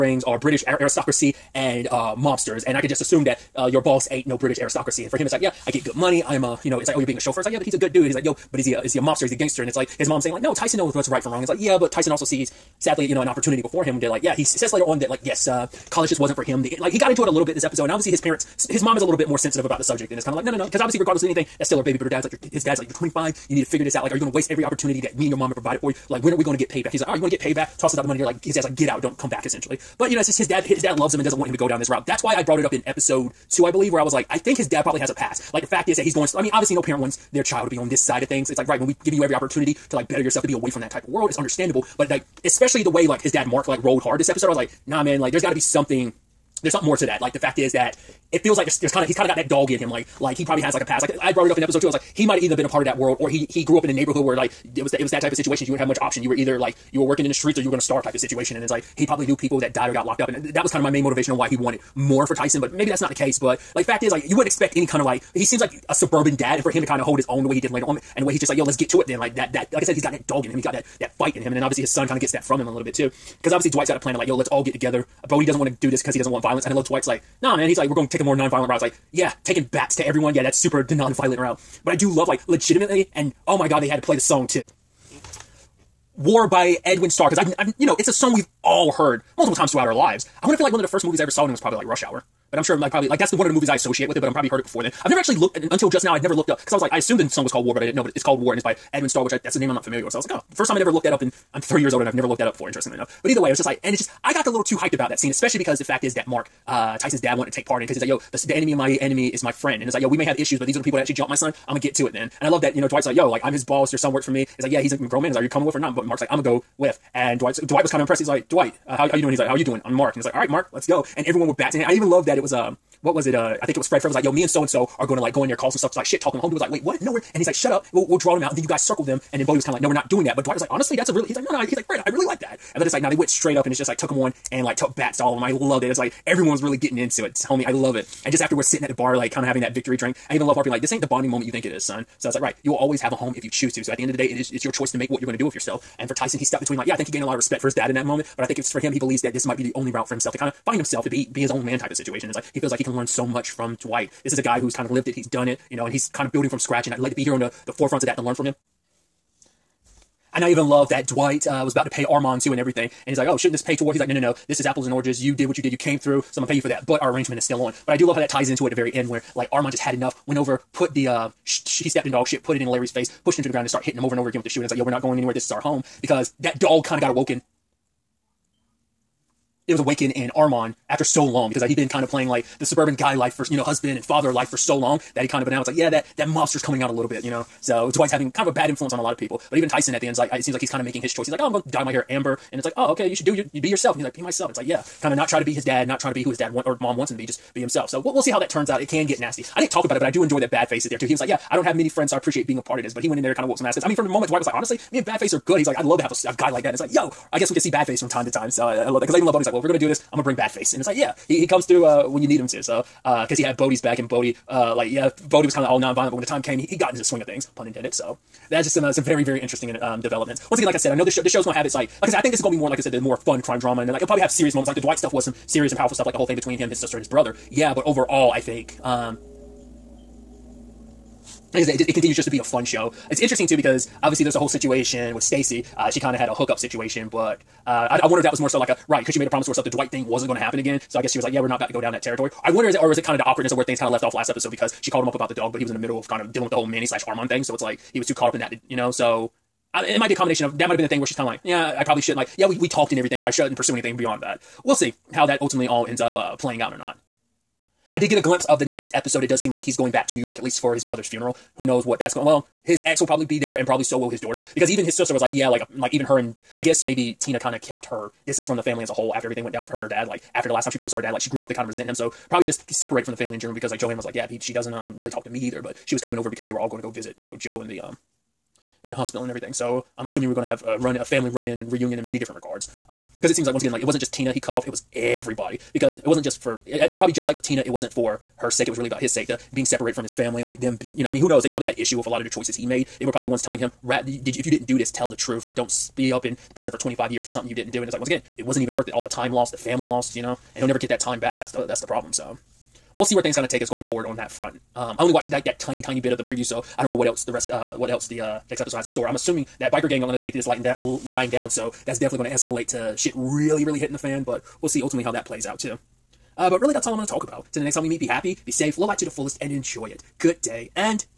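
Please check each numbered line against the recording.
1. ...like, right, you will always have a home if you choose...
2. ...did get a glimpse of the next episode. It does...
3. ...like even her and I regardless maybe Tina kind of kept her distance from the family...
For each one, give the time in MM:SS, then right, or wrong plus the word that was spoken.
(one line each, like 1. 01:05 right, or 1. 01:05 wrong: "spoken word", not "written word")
1. 02:22 right
2. 04:17 right
3. 04:25 wrong: "guess", not "regardless".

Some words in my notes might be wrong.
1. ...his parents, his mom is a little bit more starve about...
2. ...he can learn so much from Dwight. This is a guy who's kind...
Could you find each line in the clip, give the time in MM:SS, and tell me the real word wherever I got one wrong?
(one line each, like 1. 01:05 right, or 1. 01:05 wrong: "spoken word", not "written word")
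1. 00:18 wrong: "sensitive", not "starve"
2. 02:32 right.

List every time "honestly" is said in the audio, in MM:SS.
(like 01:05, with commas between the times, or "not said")
02:10, 03:24.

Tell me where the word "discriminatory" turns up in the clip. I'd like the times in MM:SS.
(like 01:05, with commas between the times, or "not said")
not said.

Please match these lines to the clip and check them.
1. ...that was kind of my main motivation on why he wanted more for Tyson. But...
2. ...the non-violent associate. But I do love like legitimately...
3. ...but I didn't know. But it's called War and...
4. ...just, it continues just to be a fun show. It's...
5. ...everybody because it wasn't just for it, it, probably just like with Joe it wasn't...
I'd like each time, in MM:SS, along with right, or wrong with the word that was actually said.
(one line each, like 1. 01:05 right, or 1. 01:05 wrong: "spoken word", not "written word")
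1. 01:00 right
2. 01:20 wrong: "route", not "associate"
3. 01:37 right
4. 03:51 right
5. 04:44 wrong: "Tina", not "Joe".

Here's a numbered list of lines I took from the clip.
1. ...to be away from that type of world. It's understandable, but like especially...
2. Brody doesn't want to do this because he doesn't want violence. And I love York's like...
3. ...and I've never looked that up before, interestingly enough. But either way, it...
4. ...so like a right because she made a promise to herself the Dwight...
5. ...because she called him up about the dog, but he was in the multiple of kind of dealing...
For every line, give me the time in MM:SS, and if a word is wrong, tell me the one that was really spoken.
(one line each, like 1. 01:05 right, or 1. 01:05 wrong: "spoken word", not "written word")
1. 00:40 right
2. 01:15 wrong: "Dwight", not "York"
3. 01:41 right
4. 03:58 right
5. 04:04 wrong: "middle", not "multiple".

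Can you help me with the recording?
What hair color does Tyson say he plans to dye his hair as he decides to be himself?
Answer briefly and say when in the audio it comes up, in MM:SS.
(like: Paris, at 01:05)
Amber, at 03:12.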